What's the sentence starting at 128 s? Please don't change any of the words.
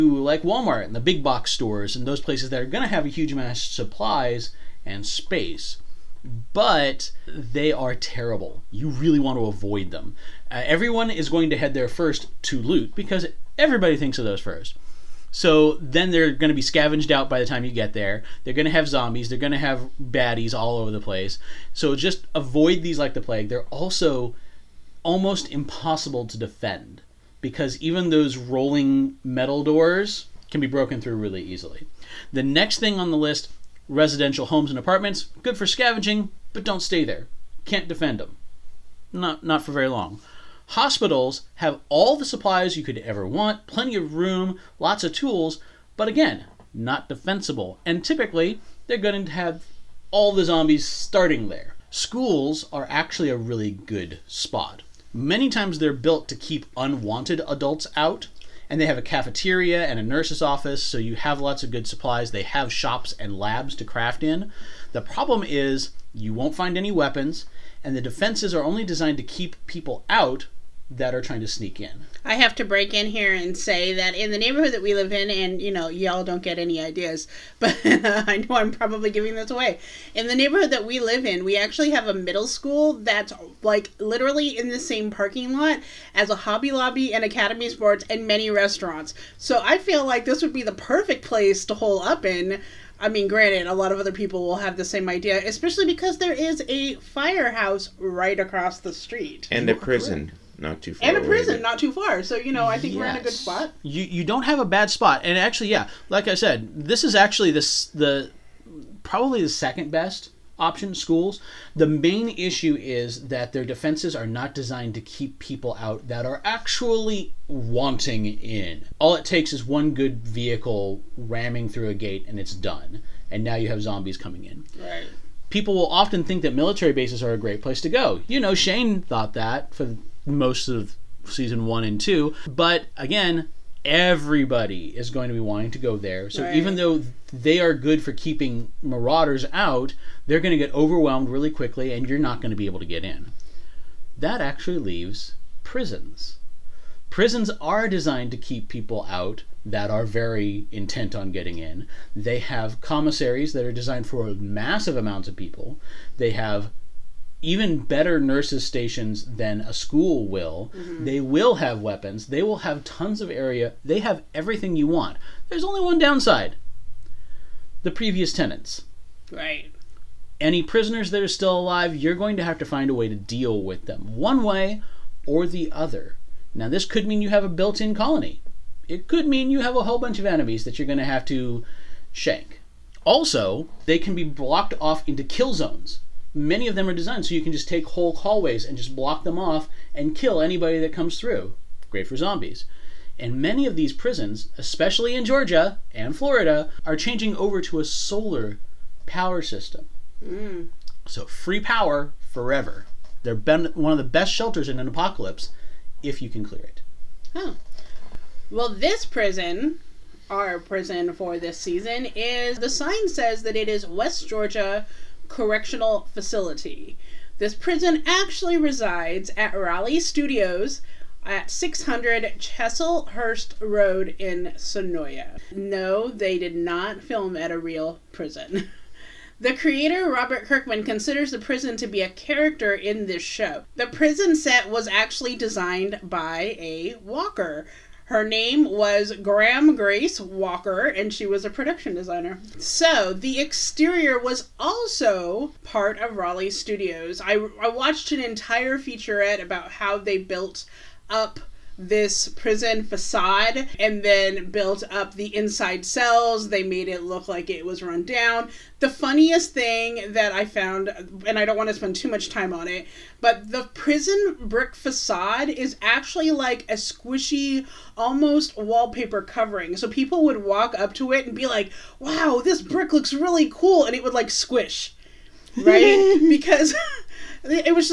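You know, Shane thought that for most of season one and two.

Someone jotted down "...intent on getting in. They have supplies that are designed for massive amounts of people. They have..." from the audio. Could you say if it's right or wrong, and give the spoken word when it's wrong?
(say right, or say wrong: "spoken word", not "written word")
wrong: "commissaries", not "supplies".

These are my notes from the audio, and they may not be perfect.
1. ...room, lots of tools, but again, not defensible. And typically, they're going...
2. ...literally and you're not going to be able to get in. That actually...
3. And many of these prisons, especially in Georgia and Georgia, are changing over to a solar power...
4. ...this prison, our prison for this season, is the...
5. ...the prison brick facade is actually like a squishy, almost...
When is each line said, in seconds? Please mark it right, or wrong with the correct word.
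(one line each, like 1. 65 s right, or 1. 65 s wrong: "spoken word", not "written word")
1. 44 s right
2. 141 s wrong: "quickly", not "literally"
3. 193 s wrong: "Florida", not "Georgia"
4. 208 s right
5. 263 s right.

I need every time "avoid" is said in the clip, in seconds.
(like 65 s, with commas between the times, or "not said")
9 s, 22 s.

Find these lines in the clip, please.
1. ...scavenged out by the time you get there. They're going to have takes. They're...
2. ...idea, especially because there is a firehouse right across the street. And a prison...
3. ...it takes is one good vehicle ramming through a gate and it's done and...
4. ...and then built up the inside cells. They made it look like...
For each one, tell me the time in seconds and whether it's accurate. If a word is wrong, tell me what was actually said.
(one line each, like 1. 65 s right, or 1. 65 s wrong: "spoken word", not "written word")
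1. 16 s wrong: "zombies", not "takes"
2. 95 s right
3. 119 s right
4. 253 s right.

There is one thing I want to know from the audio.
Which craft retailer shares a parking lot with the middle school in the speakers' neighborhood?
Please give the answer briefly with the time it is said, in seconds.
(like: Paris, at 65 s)
Hobby Lobby, at 86 s.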